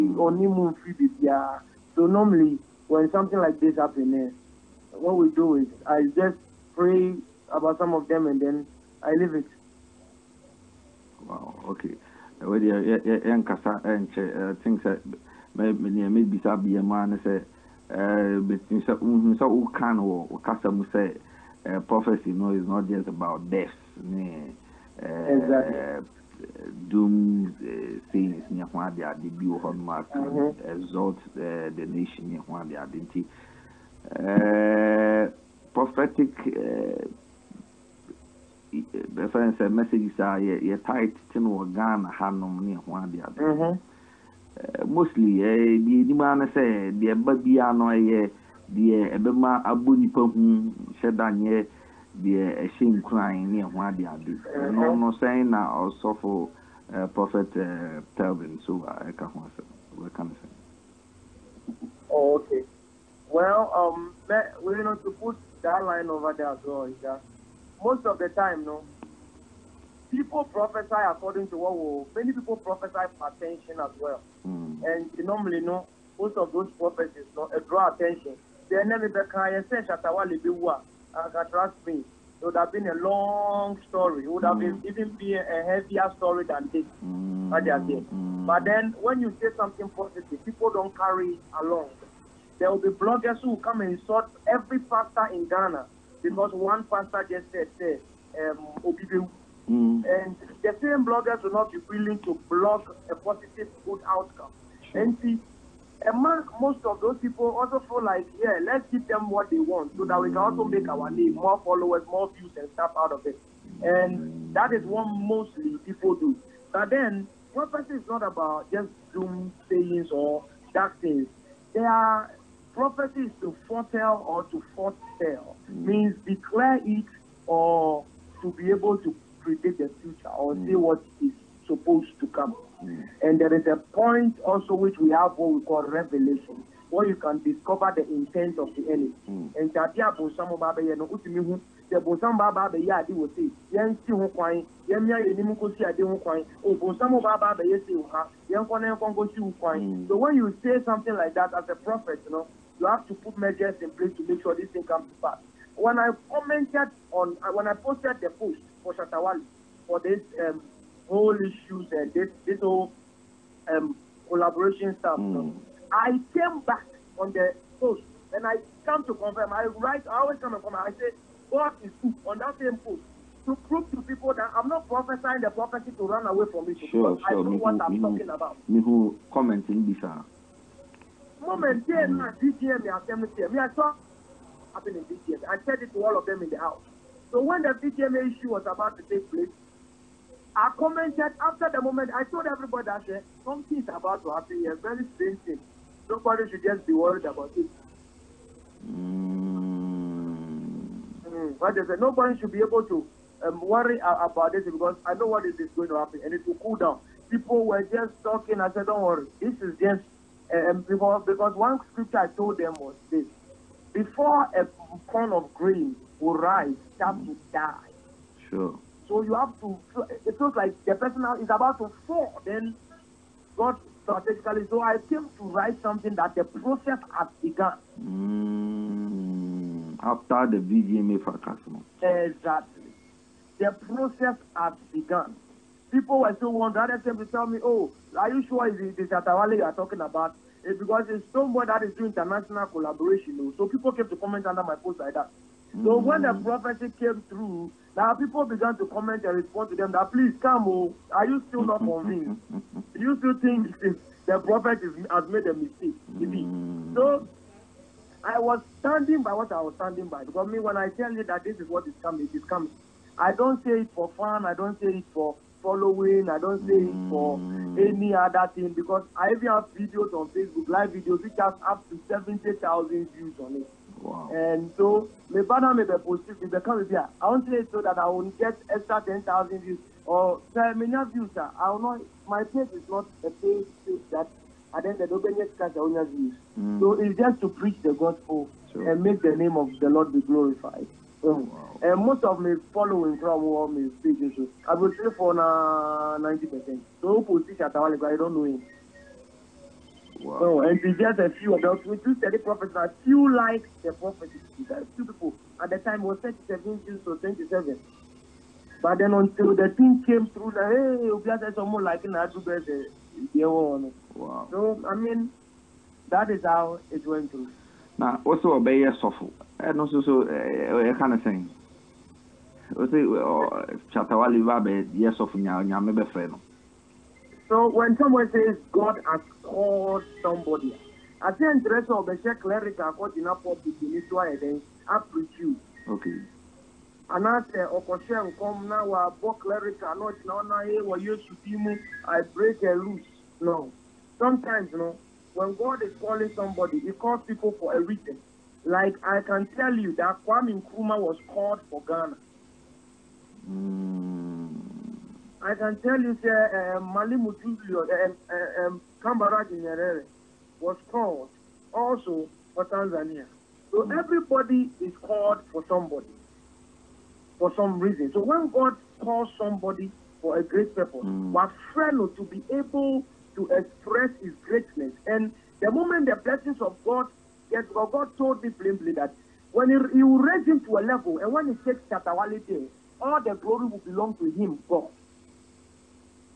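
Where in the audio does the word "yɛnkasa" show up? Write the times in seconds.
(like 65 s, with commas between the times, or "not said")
13 s.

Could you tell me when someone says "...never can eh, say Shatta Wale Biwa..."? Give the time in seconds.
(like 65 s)
78 s.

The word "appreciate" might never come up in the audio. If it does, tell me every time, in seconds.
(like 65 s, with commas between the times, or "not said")
334 s.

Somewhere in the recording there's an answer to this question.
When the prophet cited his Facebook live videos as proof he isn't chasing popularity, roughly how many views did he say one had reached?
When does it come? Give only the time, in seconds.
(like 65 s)
272 s.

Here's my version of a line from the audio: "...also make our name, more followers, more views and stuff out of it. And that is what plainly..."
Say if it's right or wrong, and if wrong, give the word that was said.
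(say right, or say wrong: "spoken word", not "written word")
wrong: "mostly", not "plainly".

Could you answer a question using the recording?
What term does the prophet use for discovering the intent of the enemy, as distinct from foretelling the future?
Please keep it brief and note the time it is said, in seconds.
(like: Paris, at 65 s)
Revelation, at 135 s.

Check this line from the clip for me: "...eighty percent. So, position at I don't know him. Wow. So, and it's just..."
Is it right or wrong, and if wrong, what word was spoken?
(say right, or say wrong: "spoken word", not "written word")
wrong: "ninety", not "eighty".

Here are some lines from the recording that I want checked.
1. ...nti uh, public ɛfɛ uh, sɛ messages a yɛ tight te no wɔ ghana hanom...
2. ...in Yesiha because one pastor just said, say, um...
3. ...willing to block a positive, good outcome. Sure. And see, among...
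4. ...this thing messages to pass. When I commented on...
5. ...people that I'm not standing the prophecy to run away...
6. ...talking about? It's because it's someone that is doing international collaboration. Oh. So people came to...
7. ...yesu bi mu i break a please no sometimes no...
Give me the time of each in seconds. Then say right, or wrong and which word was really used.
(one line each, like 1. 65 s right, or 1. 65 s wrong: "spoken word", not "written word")
1. 33 s wrong: "prophetic", not "public"
2. 95 s wrong: "Ghana", not "Yesiha"
3. 101 s right
4. 154 s wrong: "comes", not "messages"
5. 174 s wrong: "prophesying", not "standing"
6. 239 s right
7. 340 s wrong: "loose", not "please".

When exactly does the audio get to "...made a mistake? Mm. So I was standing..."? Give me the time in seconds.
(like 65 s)
255 s.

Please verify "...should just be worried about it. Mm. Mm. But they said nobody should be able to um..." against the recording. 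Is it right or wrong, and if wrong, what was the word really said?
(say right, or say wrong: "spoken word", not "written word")
right.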